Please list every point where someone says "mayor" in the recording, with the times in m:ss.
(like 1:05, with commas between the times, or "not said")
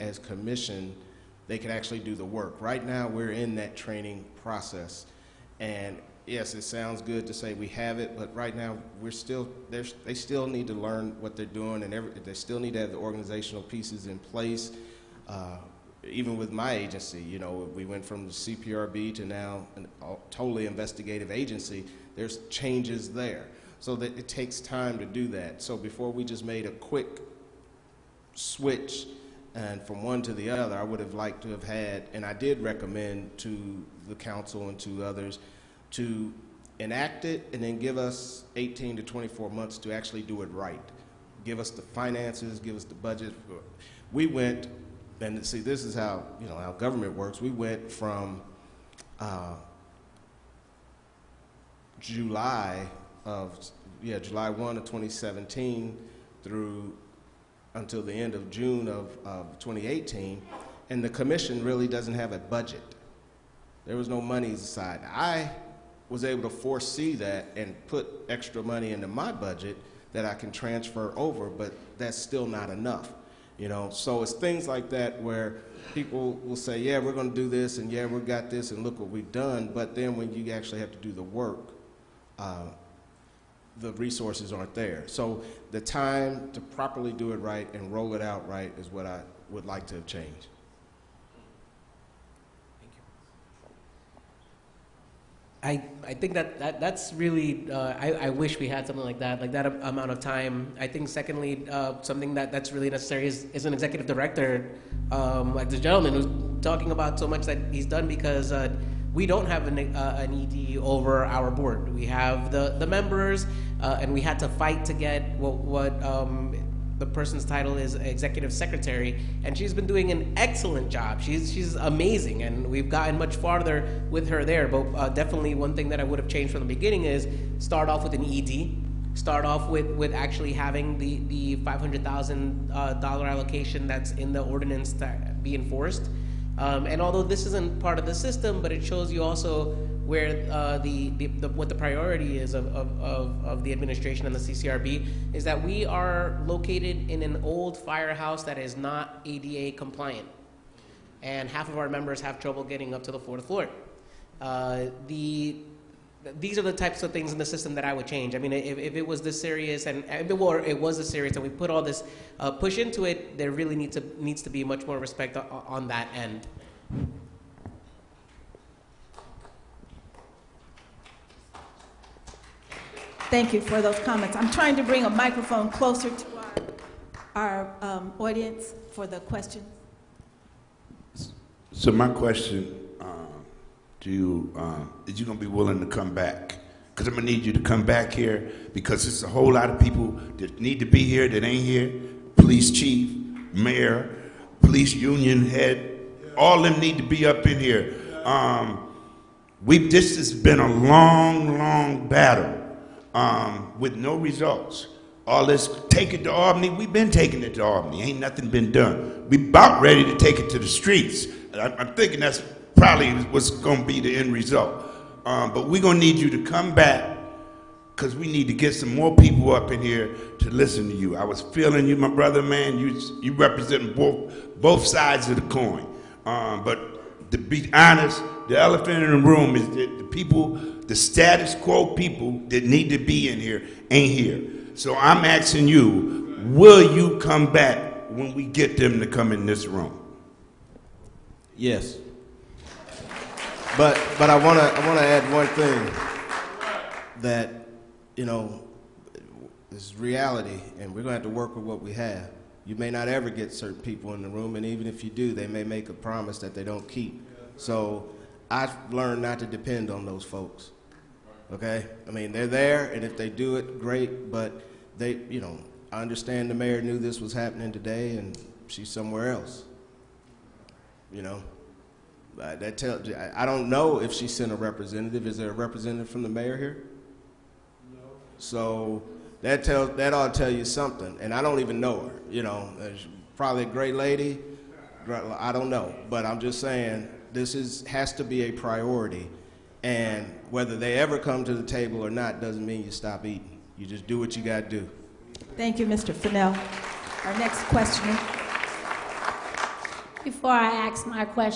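3:13, 4:26, 4:36.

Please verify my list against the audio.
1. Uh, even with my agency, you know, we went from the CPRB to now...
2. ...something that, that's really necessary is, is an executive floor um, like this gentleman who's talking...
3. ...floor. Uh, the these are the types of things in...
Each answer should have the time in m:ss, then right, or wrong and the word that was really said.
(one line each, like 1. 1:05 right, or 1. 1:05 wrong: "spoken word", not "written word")
1. 0:15 right
2. 1:42 wrong: "director", not "floor"
3. 2:33 right.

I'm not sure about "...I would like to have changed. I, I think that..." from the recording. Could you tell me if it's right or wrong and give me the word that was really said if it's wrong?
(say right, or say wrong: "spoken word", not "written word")
right.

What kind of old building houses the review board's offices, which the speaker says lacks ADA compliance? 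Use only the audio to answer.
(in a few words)
Firehouse.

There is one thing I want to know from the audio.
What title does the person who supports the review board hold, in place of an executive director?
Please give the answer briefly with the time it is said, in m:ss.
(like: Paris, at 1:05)
Executive secretary, at 1:57.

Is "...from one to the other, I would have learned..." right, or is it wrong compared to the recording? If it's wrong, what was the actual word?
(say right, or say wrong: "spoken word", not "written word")
wrong: "liked", not "learned".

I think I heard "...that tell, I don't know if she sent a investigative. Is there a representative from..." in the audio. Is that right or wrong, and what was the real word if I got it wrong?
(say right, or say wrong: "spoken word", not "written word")
wrong: "representative", not "investigative".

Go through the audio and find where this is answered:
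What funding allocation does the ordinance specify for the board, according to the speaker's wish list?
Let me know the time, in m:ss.
2:11.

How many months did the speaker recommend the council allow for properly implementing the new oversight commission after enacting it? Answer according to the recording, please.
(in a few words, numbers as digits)
18 to 24 months.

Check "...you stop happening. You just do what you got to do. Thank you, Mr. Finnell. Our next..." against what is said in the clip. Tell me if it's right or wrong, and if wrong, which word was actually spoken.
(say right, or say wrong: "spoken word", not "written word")
wrong: "eating", not "happening".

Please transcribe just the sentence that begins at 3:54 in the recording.
So I'm asking you, will you come back when we get them to come in this room?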